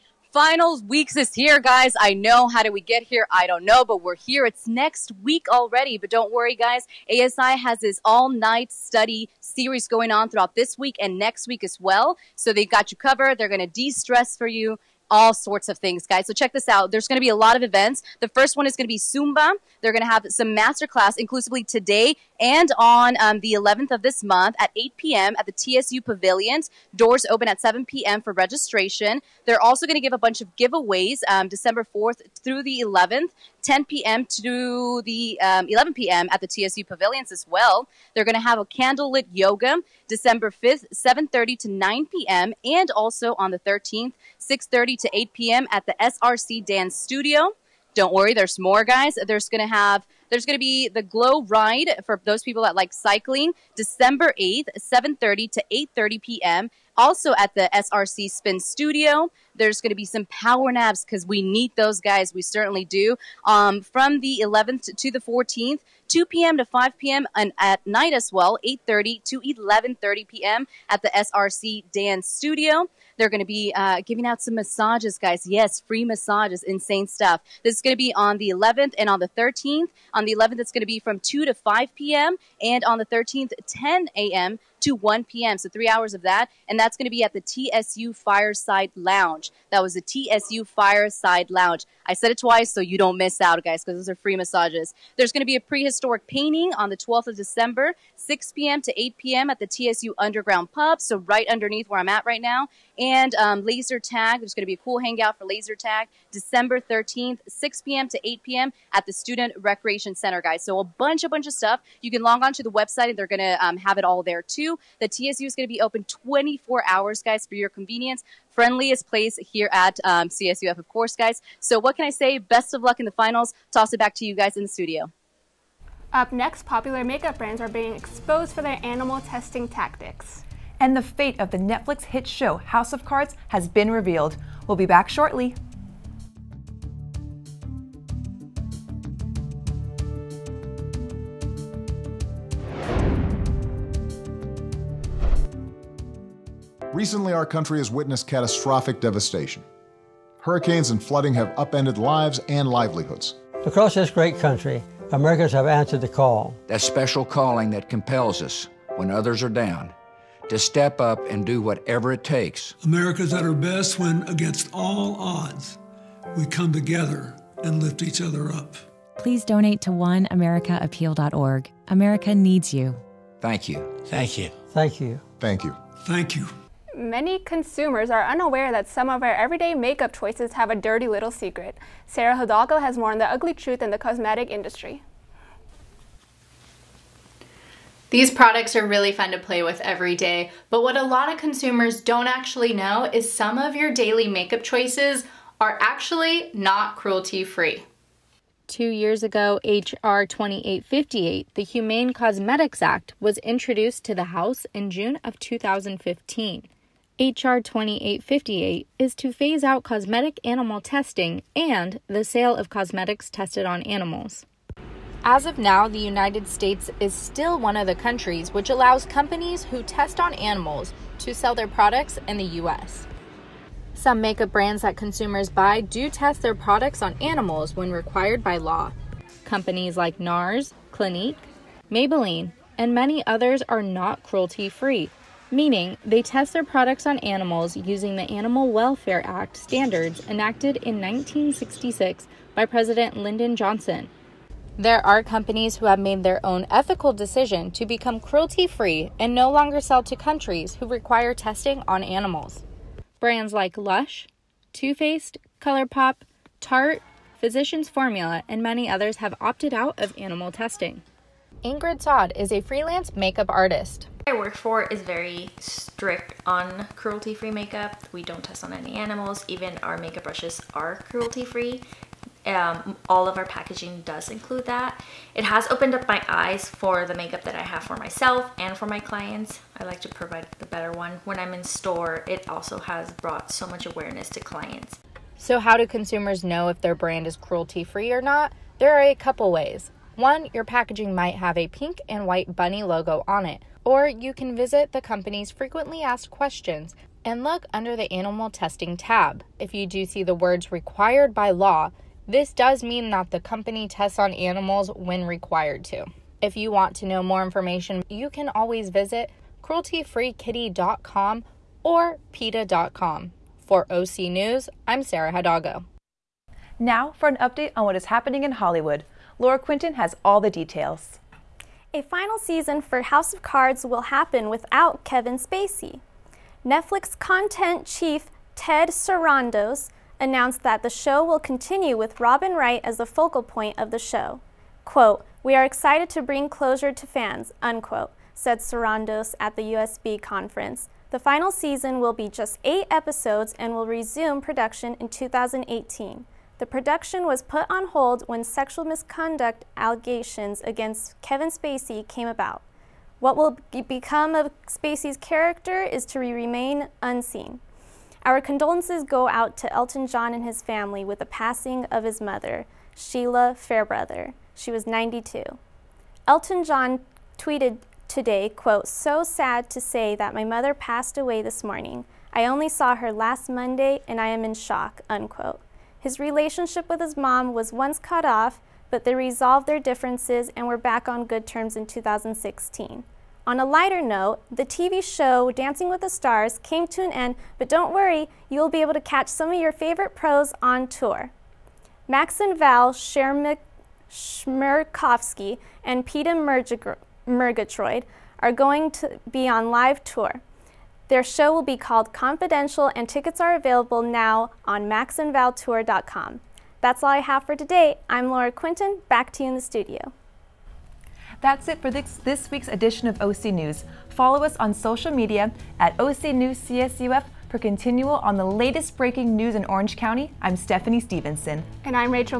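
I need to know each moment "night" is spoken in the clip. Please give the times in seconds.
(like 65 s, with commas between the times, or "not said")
8 s, 67 s.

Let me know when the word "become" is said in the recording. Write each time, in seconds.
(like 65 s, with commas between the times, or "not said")
247 s, 353 s.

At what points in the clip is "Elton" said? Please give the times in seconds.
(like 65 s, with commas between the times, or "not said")
359 s, 366 s.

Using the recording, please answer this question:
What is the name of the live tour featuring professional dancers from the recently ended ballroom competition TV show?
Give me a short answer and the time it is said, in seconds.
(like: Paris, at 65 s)
Confidential, at 402 s.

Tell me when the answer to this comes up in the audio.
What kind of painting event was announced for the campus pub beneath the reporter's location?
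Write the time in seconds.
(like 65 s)
95 s.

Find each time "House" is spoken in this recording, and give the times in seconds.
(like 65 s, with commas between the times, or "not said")
132 s, 204 s, 323 s.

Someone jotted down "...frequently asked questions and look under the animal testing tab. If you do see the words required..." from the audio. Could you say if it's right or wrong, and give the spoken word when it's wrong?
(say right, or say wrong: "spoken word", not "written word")
right.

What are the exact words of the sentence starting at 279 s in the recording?
I like to provide the better one.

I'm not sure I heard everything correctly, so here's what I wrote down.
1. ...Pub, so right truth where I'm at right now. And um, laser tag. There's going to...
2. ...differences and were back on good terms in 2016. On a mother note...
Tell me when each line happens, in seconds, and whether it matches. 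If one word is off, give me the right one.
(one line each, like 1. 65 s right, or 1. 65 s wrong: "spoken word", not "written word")
1. 100 s wrong: "underneath", not "truth"
2. 379 s wrong: "lighter", not "mother".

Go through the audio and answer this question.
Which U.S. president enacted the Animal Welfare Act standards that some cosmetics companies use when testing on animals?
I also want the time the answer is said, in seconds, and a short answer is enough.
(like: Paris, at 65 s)
Lyndon Johnson, at 243 s.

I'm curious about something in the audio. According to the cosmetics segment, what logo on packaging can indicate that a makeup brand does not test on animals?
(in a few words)
Pink and white bunny.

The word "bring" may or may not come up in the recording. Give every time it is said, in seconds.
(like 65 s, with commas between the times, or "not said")
336 s.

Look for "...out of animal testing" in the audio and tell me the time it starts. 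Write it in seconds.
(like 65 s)
259 s.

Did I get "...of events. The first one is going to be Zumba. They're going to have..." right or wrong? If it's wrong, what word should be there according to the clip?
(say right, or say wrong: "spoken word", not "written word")
right.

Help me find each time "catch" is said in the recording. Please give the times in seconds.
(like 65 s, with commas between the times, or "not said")
389 s.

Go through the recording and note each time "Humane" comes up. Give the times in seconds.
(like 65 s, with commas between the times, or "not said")
201 s.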